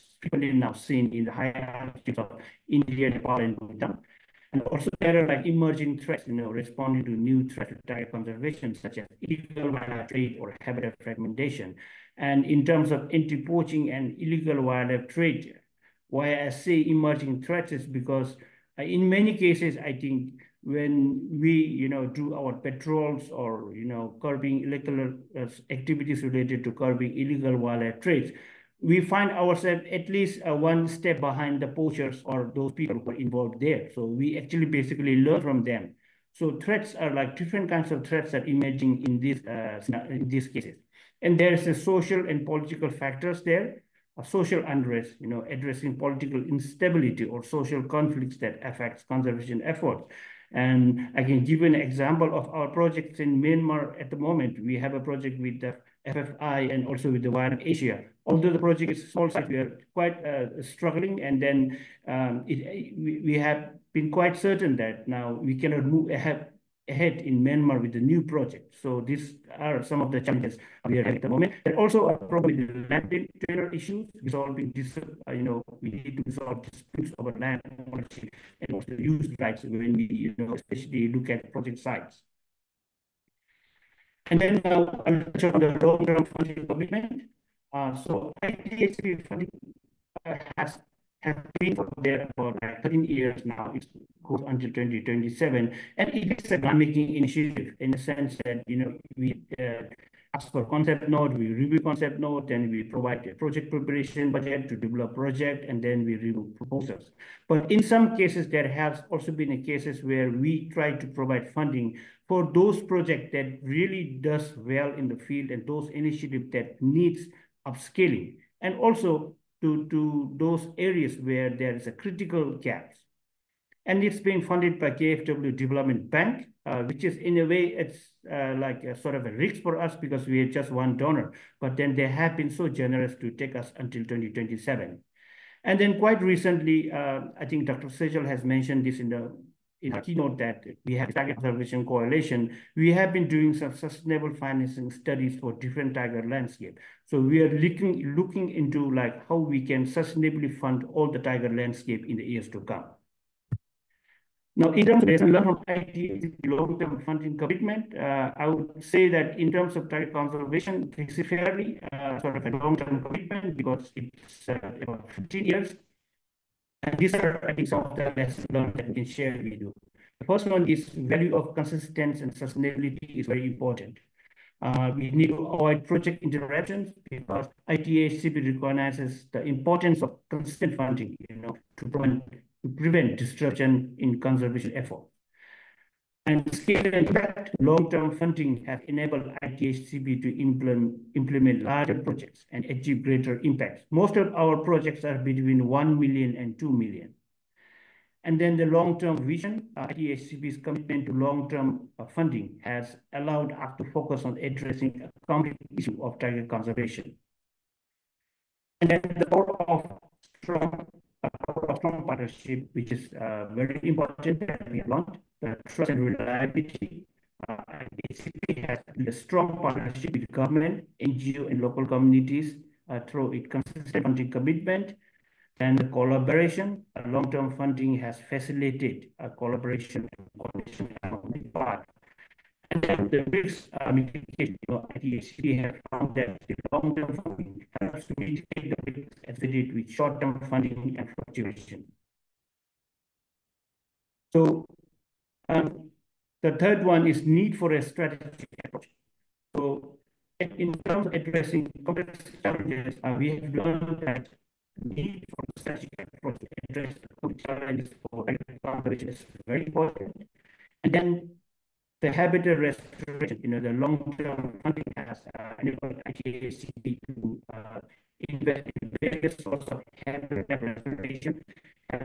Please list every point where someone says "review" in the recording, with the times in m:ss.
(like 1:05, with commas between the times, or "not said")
1:41, 1:46.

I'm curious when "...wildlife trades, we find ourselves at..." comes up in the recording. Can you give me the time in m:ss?
0:27.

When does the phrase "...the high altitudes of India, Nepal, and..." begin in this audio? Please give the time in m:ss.
0:01.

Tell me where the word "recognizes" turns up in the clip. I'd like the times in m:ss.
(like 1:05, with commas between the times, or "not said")
2:58.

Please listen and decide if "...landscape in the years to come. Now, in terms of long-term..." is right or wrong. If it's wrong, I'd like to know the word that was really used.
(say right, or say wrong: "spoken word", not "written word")
right.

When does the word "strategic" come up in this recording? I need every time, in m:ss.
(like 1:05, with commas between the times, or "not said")
4:07, 4:15.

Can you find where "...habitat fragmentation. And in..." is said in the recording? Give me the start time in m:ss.
0:10.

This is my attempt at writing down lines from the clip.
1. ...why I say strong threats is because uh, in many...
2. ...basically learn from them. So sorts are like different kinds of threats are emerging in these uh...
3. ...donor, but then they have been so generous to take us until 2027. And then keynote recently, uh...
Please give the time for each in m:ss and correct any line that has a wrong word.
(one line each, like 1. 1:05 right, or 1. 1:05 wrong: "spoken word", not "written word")
1. 0:16 wrong: "emerging", not "strong"
2. 0:34 wrong: "threats", not "sorts"
3. 2:10 wrong: "quite", not "keynote".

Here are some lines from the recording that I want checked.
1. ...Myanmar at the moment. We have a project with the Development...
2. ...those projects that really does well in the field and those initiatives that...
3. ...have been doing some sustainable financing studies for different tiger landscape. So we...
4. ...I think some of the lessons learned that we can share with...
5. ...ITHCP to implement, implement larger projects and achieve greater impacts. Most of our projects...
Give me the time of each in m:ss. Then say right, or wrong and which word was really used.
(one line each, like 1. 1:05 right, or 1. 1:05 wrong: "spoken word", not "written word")
1. 0:53 wrong: "FFI", not "Development"
2. 1:52 right
3. 2:22 right
4. 2:47 right
5. 3:09 right.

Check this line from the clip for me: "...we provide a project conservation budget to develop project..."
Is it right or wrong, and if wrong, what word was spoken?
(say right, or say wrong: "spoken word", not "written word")
wrong: "preparation", not "conservation".